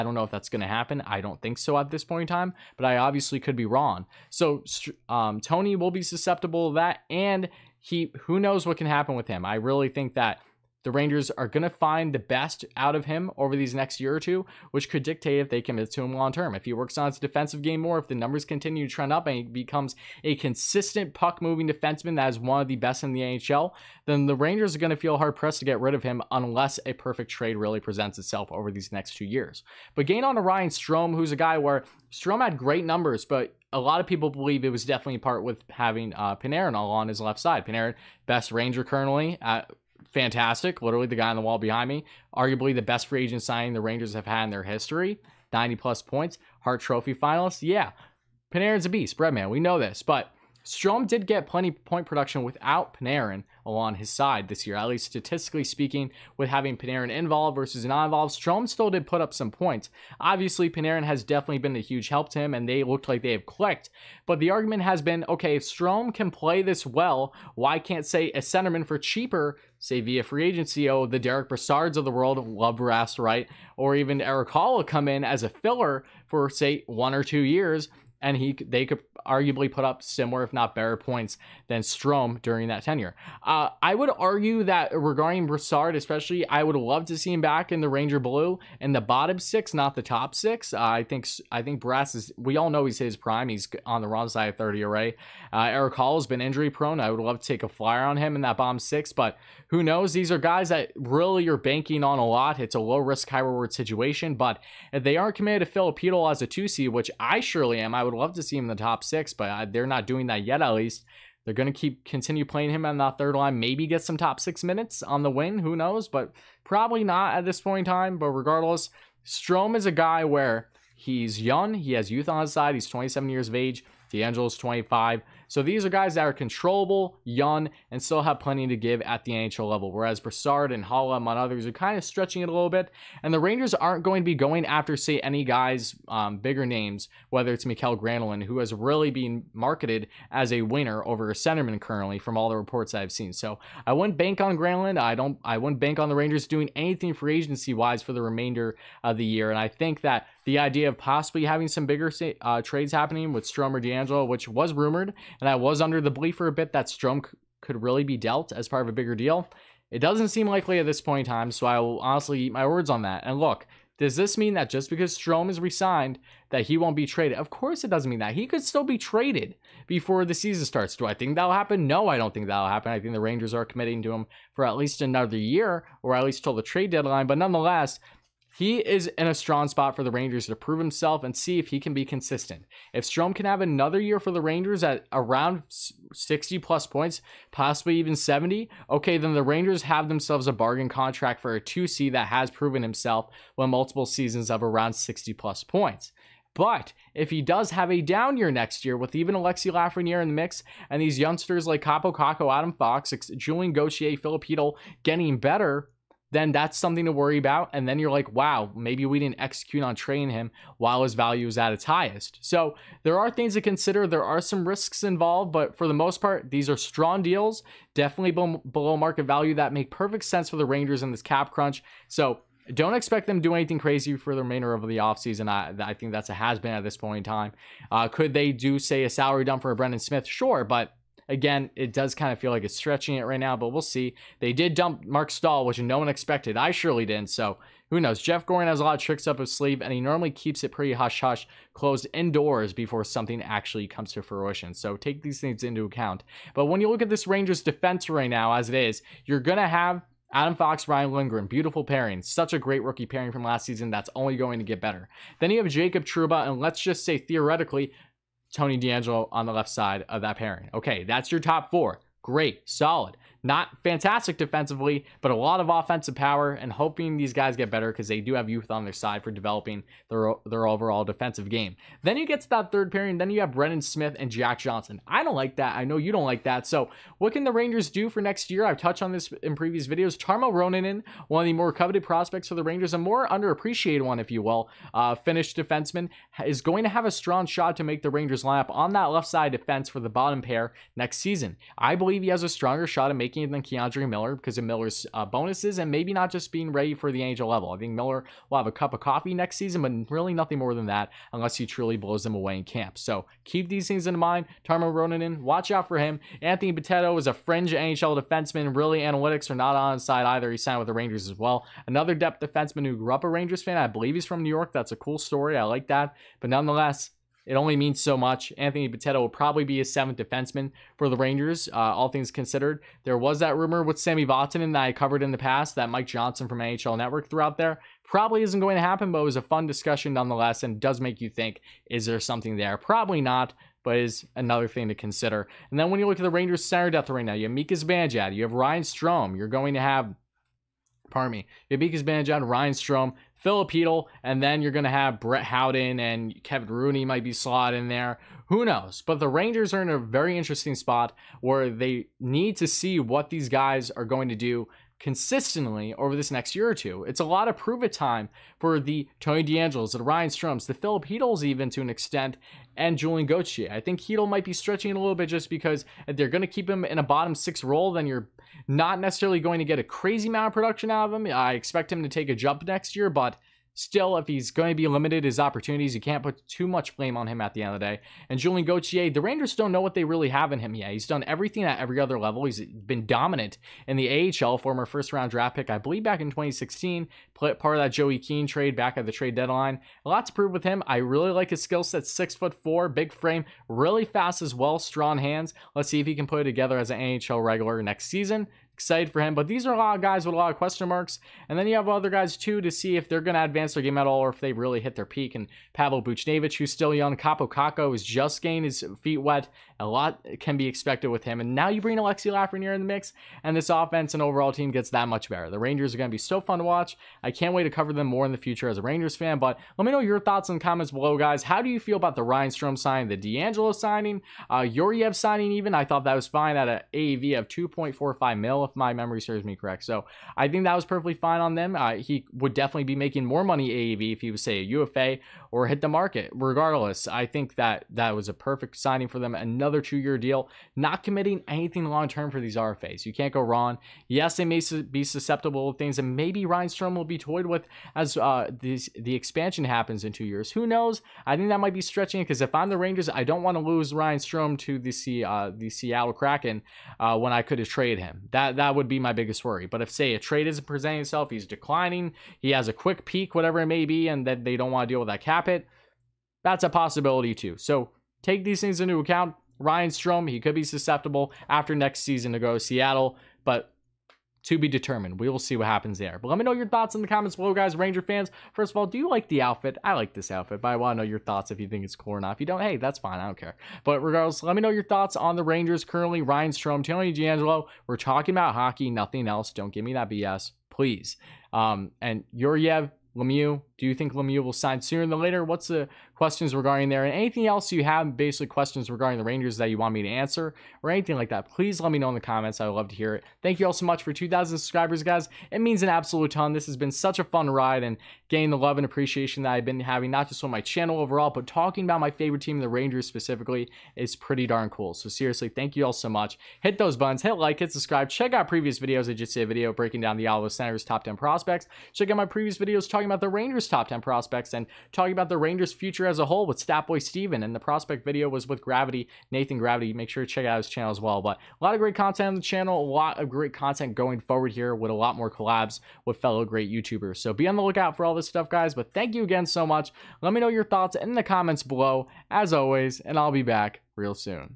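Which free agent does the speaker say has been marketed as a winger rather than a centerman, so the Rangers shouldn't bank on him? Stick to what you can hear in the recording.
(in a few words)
Mikael Granlund.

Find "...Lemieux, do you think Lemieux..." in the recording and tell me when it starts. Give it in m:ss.
8:13.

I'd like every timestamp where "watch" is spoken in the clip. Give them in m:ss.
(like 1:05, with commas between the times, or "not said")
5:05, 6:56.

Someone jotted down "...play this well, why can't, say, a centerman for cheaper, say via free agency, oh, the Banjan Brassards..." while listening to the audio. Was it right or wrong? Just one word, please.
wrong.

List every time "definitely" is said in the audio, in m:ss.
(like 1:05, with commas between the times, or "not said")
0:34, 1:01, 3:37, 7:12.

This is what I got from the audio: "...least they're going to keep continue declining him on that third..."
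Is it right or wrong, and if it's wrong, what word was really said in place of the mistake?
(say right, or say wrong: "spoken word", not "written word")
wrong: "playing", not "declining".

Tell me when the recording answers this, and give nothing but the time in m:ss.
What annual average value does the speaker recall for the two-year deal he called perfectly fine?
7:07.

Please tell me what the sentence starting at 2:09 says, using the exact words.
Whereas Brassard and Haula, among others, are kind of stretching it a little bit.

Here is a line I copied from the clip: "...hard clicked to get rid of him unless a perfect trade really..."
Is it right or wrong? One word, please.
wrong.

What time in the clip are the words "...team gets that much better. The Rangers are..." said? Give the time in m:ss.
6:54.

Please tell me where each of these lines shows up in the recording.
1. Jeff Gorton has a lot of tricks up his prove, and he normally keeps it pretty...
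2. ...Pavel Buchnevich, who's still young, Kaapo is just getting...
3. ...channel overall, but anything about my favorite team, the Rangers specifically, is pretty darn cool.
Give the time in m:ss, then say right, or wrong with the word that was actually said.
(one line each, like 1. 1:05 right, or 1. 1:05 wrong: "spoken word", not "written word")
1. 3:58 wrong: "sleeve", not "prove"
2. 6:45 right
3. 8:30 wrong: "talking", not "anything".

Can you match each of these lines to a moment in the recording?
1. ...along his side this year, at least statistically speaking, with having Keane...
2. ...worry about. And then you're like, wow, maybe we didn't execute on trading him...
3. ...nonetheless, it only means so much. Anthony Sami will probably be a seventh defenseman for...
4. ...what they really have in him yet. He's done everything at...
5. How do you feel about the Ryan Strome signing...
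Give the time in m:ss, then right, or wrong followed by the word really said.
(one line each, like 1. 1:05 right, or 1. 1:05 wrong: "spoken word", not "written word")
1. 0:53 wrong: "Panarin", not "Keane"
2. 3:27 right
3. 5:16 wrong: "Bitetto", not "Sami"
4. 6:19 right
5. 7:01 right.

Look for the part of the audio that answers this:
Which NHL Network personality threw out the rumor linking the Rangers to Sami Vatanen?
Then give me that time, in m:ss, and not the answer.
5:25.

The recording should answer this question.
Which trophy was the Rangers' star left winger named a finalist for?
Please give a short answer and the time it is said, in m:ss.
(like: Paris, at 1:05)
Hart Trophy, at 0:46.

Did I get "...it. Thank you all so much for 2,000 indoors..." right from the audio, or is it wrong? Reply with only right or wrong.
wrong.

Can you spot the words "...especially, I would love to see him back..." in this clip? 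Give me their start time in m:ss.
1:25.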